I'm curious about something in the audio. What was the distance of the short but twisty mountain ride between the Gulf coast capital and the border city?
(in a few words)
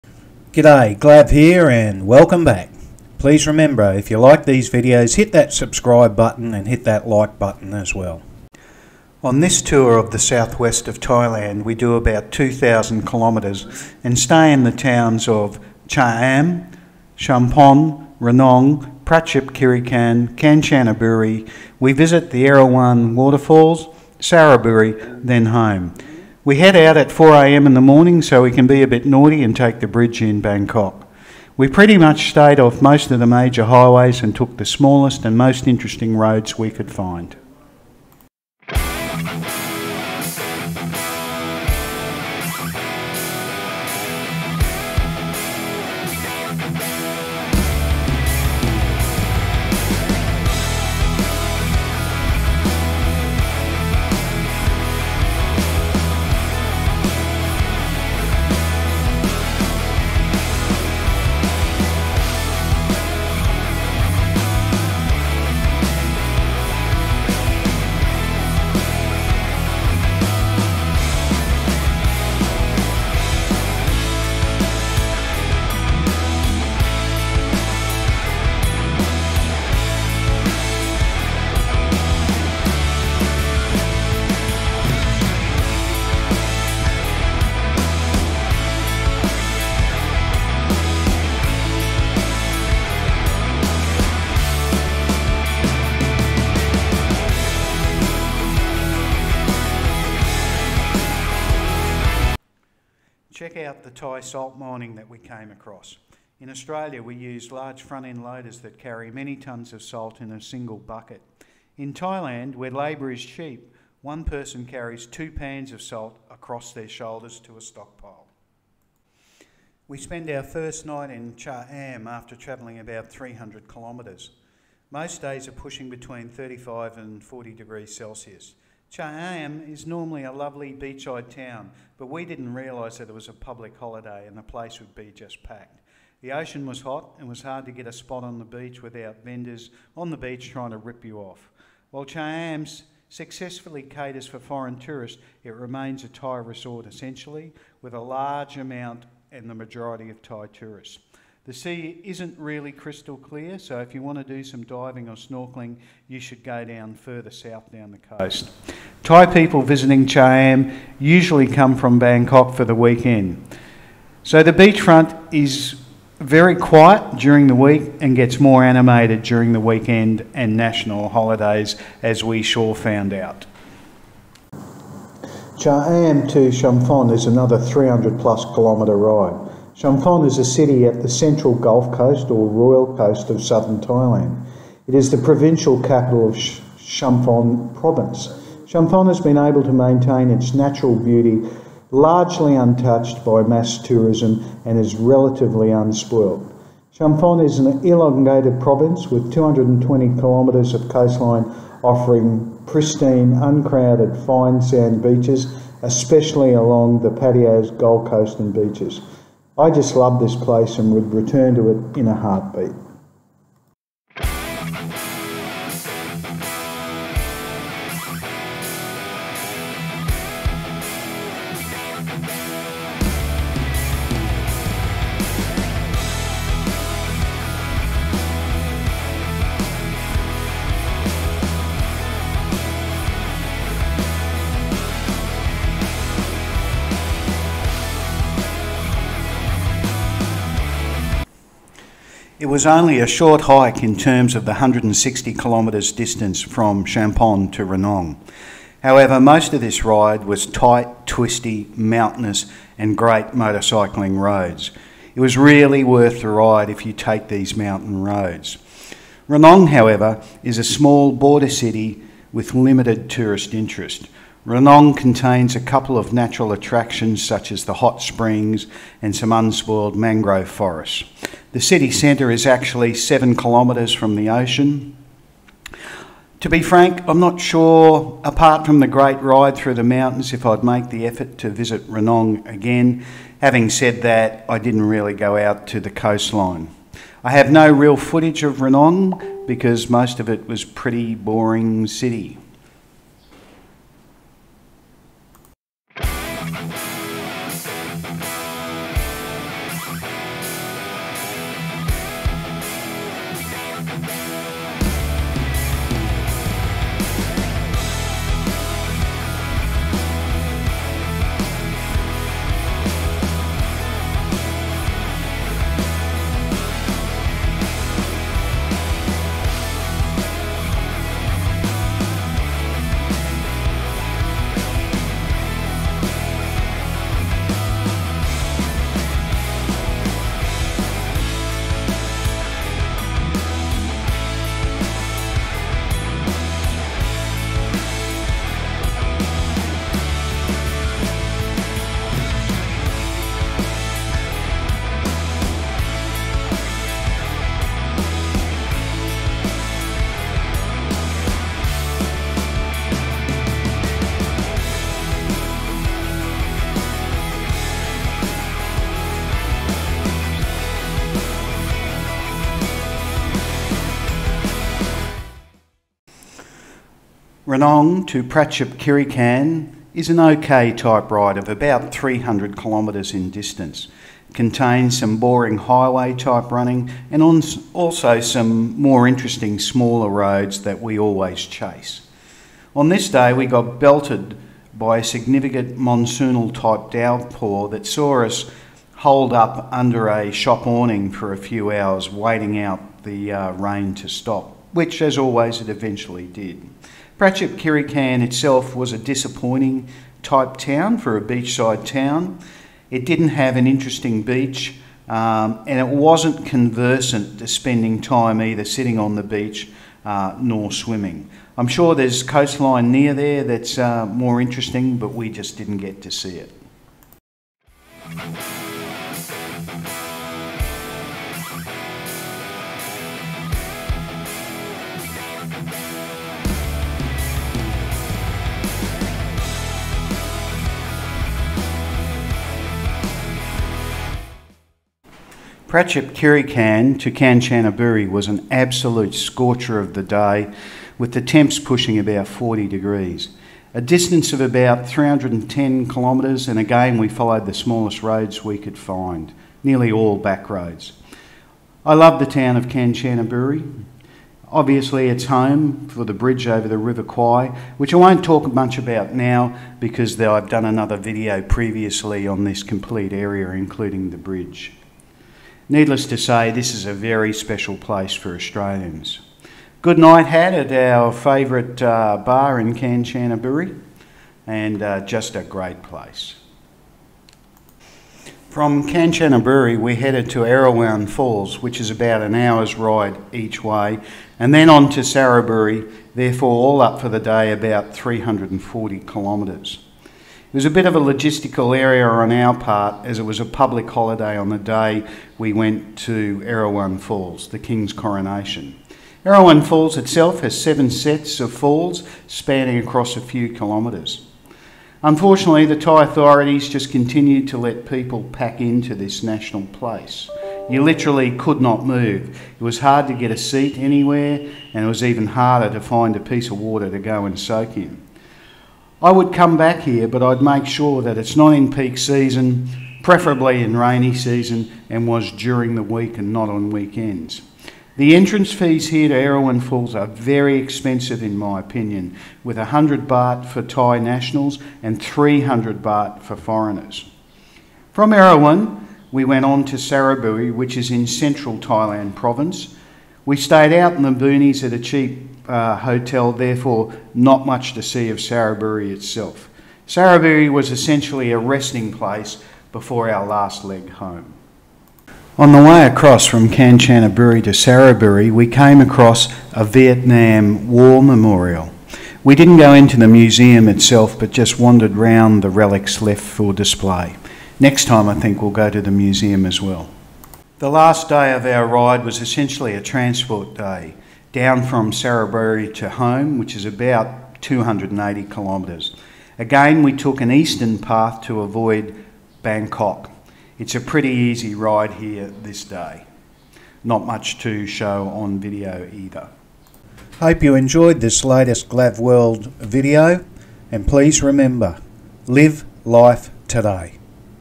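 160 kilometres.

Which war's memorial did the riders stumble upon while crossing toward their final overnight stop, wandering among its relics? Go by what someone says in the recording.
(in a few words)
Vietnam War.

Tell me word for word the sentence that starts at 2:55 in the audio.
Cha-am to Chumphon is another 300 plus kilometre ride.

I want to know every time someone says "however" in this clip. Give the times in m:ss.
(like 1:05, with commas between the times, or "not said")
4:08, 4:19.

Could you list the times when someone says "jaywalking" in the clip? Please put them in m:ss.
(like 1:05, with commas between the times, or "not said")
not said.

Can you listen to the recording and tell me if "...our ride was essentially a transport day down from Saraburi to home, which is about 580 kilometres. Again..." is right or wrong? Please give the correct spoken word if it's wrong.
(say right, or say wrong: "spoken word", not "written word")
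wrong: "280", not "580".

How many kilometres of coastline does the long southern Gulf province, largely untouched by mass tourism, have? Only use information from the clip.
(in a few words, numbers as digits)
220.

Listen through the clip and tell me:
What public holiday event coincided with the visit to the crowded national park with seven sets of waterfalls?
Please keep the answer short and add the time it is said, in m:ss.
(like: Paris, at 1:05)
King's coronation, at 8:17.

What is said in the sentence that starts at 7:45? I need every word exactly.
Needless to say, this is a very special place for Australians.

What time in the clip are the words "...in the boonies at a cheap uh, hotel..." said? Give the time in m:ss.
9:03.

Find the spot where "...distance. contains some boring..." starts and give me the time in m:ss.
6:13.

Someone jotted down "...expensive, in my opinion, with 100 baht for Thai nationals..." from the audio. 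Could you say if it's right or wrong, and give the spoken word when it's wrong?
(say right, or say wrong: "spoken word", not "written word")
right.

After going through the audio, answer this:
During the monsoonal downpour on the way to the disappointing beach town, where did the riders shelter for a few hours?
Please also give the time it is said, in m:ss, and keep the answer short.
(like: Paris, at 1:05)
under a shop awning, at 6:29.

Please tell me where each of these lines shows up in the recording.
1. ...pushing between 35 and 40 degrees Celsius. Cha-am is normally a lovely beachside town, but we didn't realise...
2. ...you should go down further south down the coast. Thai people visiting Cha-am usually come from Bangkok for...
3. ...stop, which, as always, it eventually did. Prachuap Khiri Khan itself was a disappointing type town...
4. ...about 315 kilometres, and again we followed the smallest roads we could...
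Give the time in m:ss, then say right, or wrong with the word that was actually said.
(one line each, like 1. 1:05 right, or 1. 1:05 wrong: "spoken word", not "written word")
1. 2:05 right
2. 2:36 right
3. 6:34 right
4. 7:24 wrong: "310", not "315".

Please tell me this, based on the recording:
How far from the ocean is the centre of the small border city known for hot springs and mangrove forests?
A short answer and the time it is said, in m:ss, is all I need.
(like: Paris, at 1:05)
7 kilometres, at 4:32.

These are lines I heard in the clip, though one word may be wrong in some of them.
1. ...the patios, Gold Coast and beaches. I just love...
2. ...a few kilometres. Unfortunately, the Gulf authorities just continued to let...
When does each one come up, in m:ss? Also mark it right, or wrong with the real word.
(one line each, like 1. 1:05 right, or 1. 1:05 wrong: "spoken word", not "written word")
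1. 3:27 right
2. 8:23 wrong: "Thai", not "Gulf".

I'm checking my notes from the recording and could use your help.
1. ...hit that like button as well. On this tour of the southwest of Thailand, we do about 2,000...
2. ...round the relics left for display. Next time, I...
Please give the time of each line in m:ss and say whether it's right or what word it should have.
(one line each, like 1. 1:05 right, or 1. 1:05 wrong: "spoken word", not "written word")
1. 0:06 right
2. 9:24 right.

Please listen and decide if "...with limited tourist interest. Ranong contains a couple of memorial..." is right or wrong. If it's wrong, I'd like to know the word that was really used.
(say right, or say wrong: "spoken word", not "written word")
wrong: "natural", not "memorial".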